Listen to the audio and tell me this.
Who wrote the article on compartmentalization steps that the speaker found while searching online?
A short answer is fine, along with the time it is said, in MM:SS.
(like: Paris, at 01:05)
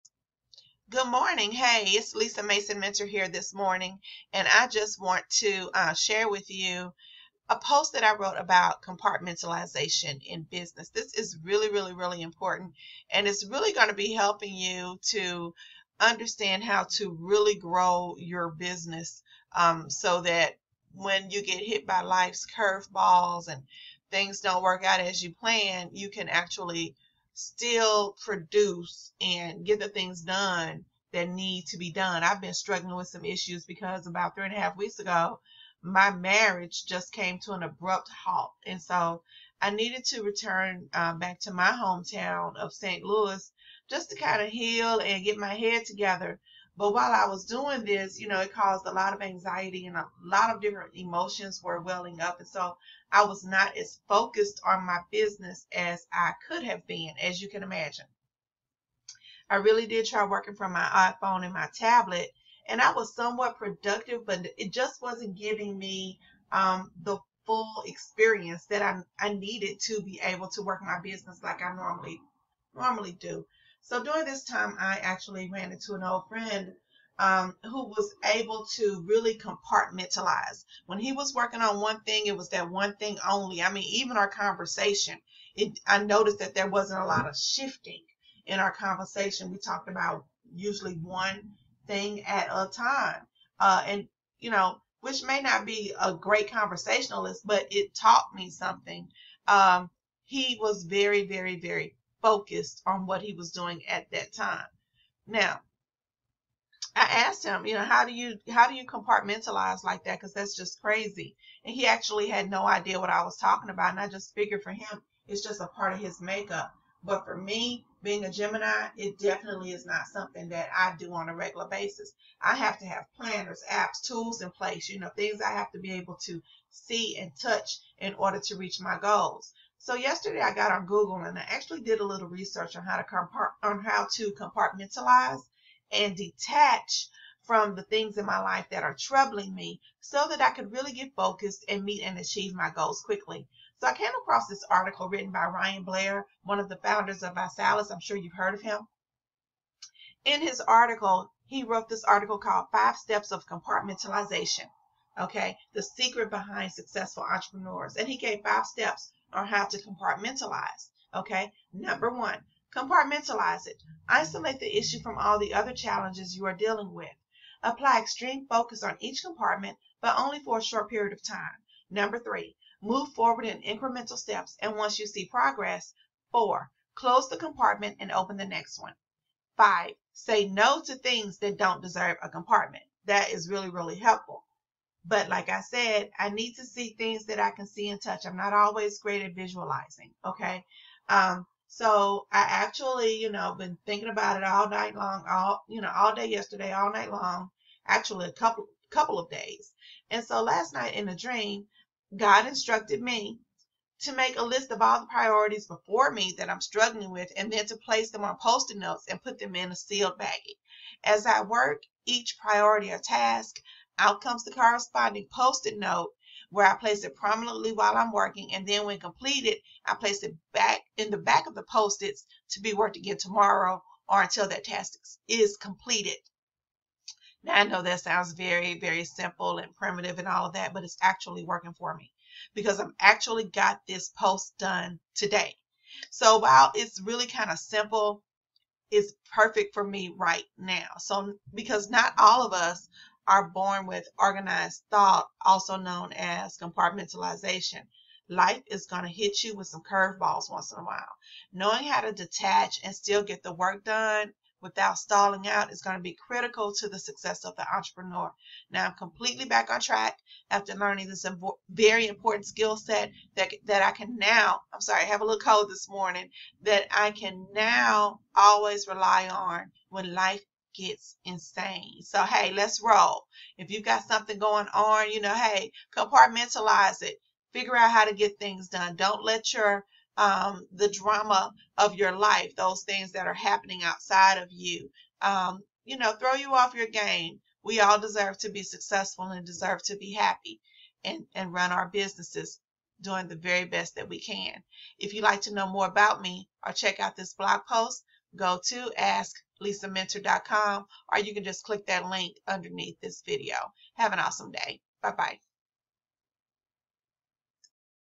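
Ryan Blair, at 02:25.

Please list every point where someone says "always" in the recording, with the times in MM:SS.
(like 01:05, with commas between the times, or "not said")
03:08, 04:28.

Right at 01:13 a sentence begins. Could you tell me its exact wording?
So during this time, I actually ran into an old friend um, who was able to really compartmentalize.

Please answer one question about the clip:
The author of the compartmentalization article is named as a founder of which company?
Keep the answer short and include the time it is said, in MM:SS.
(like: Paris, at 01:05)
ViSalus, at 02:27.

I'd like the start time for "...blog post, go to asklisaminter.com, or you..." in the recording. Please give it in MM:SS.
04:57.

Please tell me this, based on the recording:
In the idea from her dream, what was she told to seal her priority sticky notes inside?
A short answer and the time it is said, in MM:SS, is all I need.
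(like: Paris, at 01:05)
sealed baggie, at 03:29.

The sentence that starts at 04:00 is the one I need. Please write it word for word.
So because not all of us are born with organized thought, also known as compartmentalization.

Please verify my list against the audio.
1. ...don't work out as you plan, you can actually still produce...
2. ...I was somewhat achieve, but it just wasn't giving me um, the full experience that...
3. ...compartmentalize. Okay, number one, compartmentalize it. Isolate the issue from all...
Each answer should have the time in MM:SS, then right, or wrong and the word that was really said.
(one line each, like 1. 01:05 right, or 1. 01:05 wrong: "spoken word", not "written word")
1. 00:24 right
2. 01:02 wrong: "productive", not "achieve"
3. 02:39 right.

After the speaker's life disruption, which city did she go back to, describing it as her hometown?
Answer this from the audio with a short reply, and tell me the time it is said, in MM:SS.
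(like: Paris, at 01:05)
St. Louis, at 00:42.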